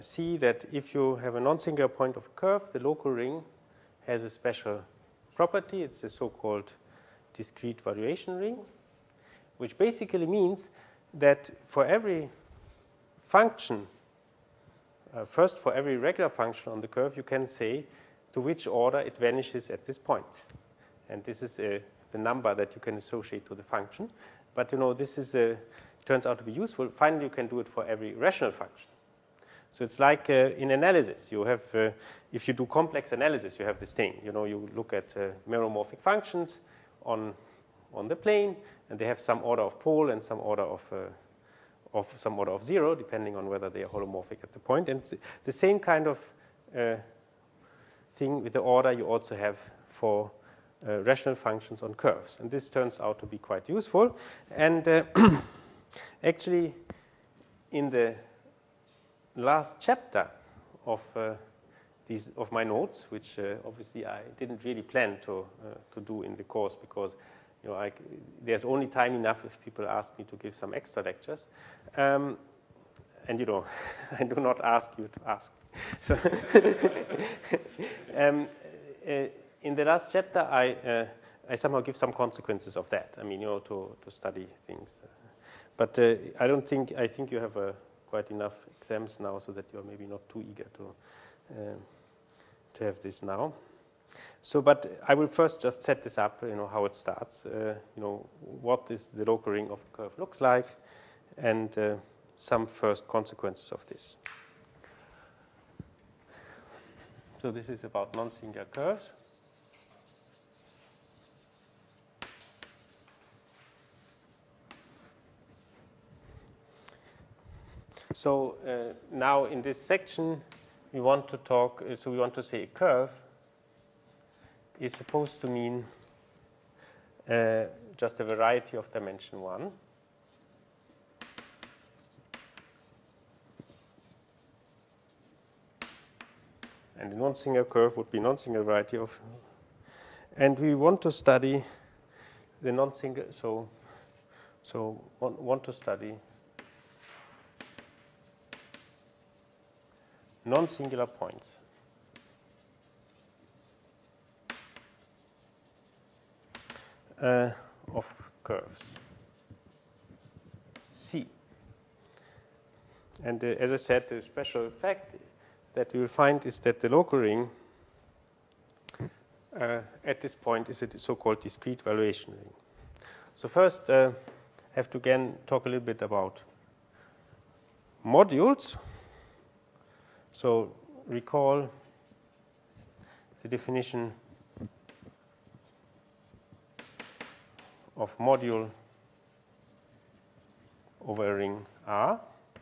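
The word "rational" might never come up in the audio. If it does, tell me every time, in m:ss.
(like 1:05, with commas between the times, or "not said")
0:28, 0:51.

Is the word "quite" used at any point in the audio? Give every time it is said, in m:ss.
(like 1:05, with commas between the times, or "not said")
0:53, 1:28.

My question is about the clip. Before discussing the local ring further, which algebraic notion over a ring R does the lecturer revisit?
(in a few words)
Modules.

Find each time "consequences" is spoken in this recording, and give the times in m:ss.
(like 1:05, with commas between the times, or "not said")
1:22, 1:43.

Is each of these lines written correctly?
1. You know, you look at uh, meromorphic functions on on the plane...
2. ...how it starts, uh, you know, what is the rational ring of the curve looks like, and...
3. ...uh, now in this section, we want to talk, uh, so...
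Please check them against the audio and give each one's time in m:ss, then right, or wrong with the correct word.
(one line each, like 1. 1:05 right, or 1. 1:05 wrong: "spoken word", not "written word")
1. 0:34 right
2. 1:36 wrong: "local", not "rational"
3. 1:58 right.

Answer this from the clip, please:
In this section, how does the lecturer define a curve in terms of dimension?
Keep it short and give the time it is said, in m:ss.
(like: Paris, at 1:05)
A variety of dimension 1, at 2:08.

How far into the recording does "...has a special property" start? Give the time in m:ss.
0:04.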